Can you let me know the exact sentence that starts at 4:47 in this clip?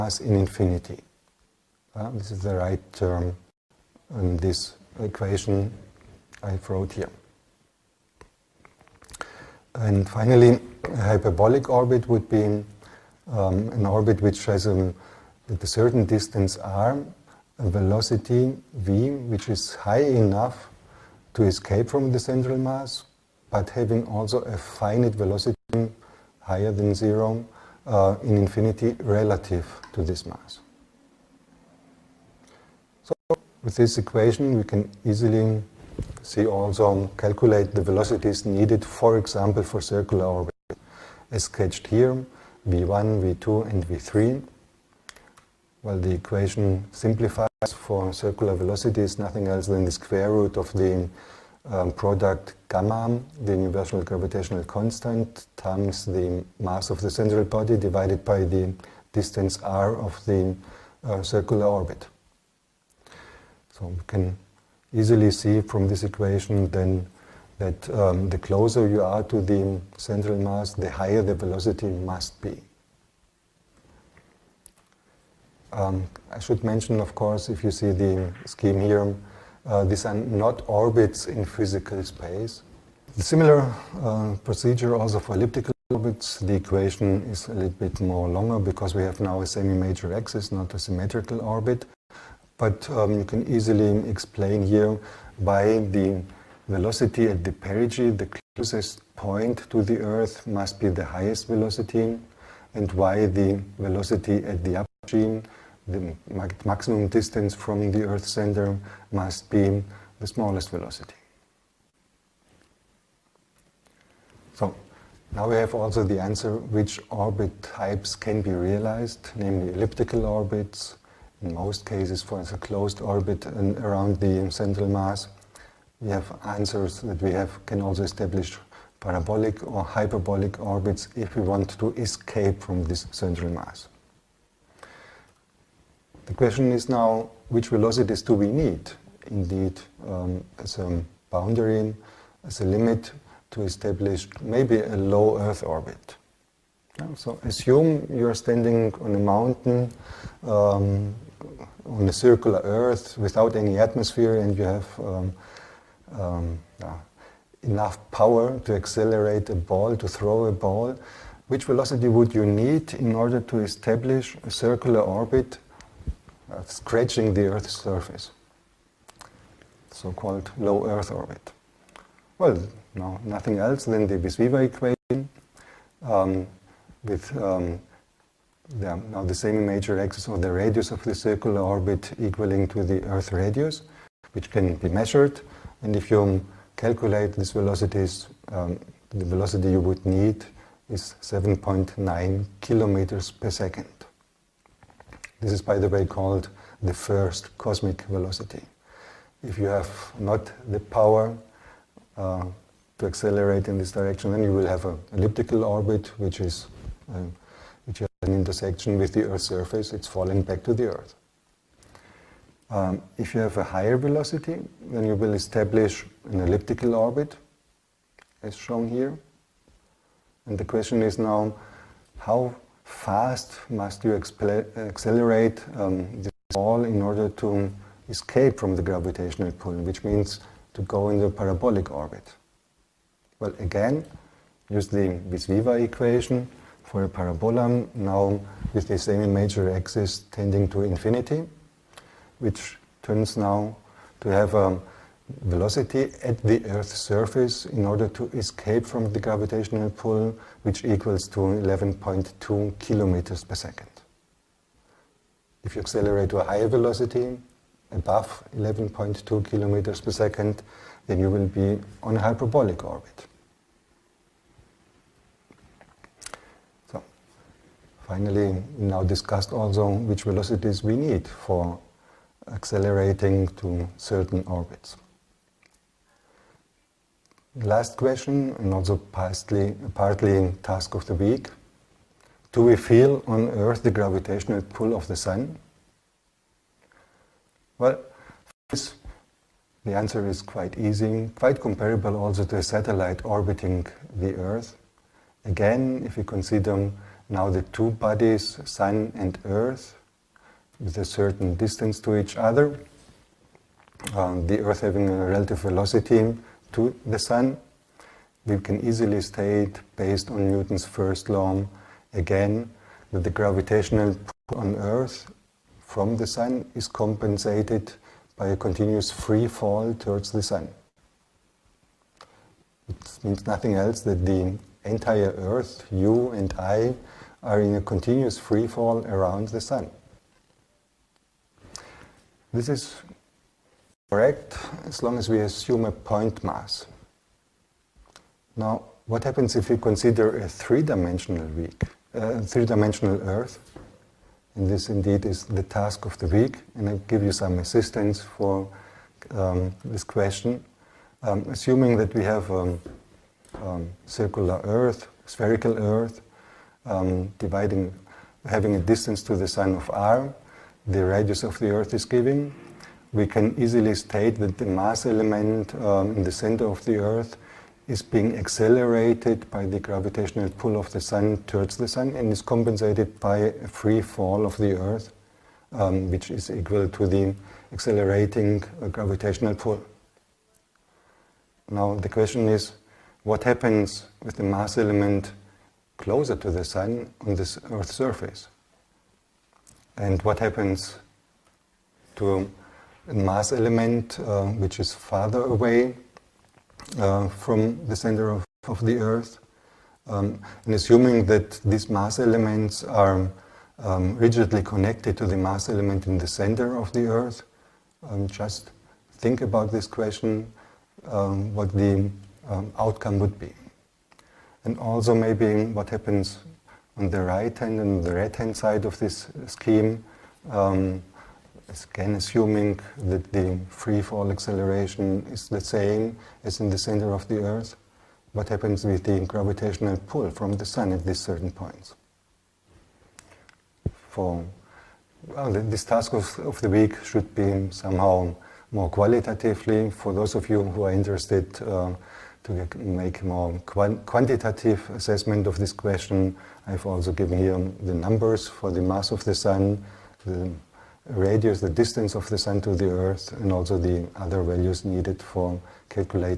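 Well, this, the answer is quite easy, quite comparable also to a satellite orbiting the Earth.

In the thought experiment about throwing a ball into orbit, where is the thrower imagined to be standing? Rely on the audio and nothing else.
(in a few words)
on a mountain.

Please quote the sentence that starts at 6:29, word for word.
And what happens to mass element, uh, which is farther away uh, from the center of, of the Earth.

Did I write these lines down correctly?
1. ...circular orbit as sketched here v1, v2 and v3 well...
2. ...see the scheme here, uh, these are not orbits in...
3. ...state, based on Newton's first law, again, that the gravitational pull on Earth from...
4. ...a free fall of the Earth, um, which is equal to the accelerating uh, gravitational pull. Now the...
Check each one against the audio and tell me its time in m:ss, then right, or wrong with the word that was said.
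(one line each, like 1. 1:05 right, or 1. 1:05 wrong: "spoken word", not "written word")
1. 0:39 right
2. 1:17 right
3. 5:09 right
4. 6:13 right.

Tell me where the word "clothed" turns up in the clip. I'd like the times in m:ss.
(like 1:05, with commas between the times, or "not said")
not said.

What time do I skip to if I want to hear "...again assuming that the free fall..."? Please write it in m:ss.
7:01.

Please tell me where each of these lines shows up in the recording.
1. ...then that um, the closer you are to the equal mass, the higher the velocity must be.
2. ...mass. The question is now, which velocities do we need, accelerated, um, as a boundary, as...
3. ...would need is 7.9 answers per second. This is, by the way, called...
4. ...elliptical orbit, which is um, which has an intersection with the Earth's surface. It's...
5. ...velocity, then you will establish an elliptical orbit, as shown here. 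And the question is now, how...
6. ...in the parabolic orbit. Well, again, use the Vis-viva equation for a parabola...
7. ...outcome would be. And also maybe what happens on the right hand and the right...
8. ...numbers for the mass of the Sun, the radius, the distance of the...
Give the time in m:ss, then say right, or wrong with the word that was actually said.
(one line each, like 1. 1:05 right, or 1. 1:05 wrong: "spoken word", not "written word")
1. 1:06 wrong: "central", not "equal"
2. 2:13 wrong: "indeed", not "accelerated"
3. 3:09 wrong: "kilometers", not "answers"
4. 3:25 right
5. 3:33 right
6. 3:51 right
7. 6:52 right
8. 7:27 right.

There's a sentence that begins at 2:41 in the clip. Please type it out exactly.
Which velocity would you need in order to establish a circular orbit uh, scratching the Earth's surface, so-called low Earth orbit.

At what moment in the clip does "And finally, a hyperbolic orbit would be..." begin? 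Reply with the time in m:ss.
0:09.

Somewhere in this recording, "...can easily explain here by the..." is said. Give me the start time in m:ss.
1:33.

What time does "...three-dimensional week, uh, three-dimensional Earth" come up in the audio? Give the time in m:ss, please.
5:40.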